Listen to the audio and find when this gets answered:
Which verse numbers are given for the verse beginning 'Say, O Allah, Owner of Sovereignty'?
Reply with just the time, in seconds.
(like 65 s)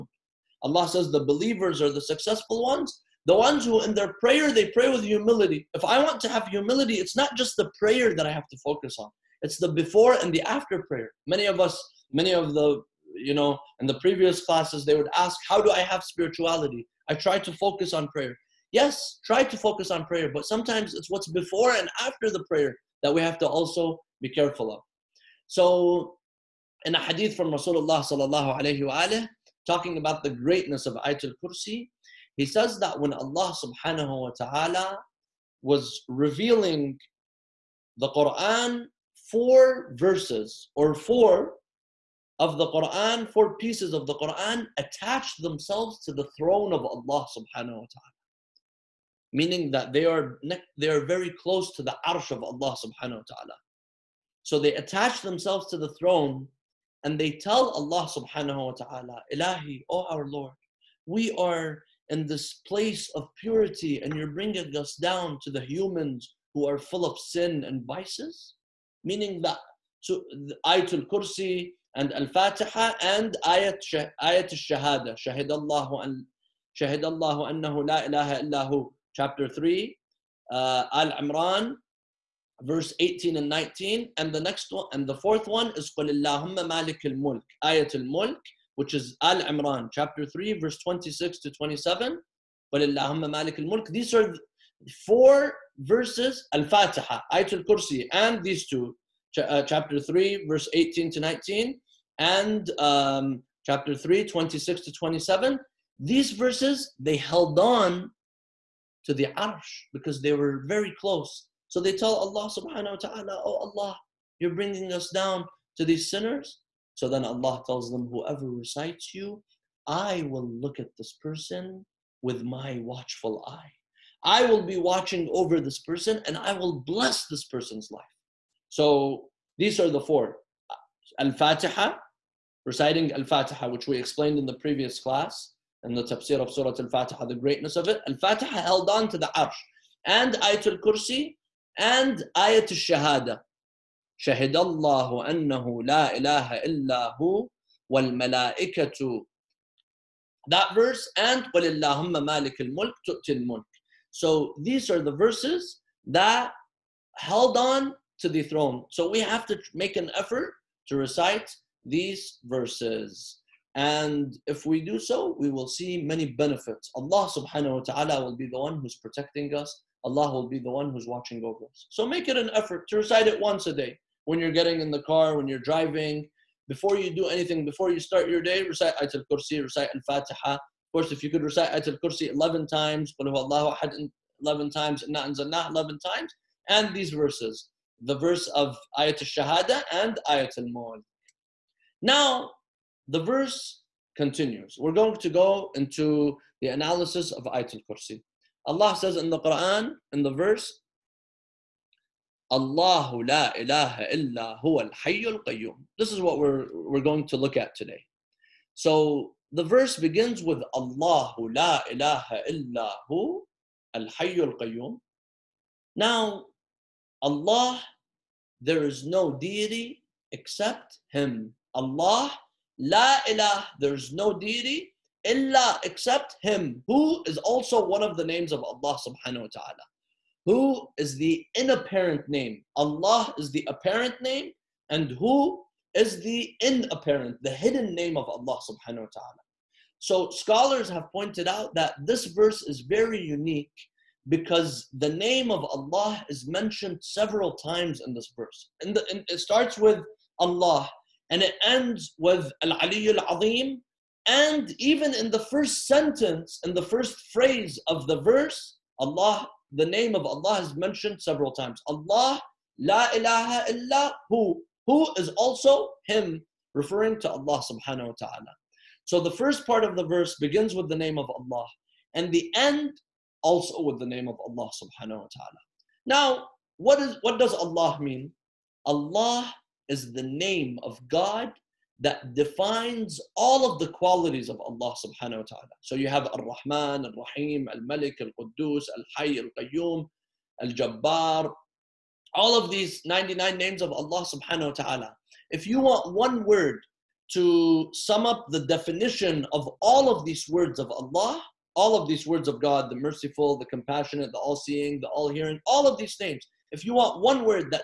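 90 s.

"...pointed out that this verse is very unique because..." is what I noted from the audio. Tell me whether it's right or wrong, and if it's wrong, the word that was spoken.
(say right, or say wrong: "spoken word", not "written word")
right.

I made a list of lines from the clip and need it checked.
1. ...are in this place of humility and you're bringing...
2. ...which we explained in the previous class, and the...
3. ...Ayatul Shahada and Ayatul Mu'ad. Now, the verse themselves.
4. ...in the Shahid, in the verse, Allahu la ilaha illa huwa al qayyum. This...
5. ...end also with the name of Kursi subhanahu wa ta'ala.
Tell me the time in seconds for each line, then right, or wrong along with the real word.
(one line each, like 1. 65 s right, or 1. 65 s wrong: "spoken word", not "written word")
1. 61 s wrong: "purity", not "humility"
2. 133 s right
3. 188 s wrong: "continues", not "themselves"
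4. 199 s wrong: "Quran", not "Shahid"
5. 272 s wrong: "Allah", not "Kursi".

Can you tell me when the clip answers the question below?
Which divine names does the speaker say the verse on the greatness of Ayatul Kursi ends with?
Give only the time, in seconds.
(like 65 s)
252 s.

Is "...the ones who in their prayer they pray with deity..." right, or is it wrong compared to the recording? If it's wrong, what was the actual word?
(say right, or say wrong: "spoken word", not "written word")
wrong: "humility", not "deity".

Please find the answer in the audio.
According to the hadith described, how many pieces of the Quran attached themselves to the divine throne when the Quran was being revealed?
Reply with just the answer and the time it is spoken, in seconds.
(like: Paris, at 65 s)
4, at 43 s.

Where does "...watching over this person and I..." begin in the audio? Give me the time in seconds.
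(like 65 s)
124 s.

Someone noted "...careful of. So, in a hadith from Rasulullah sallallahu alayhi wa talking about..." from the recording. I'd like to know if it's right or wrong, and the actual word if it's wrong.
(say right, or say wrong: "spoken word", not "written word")
right.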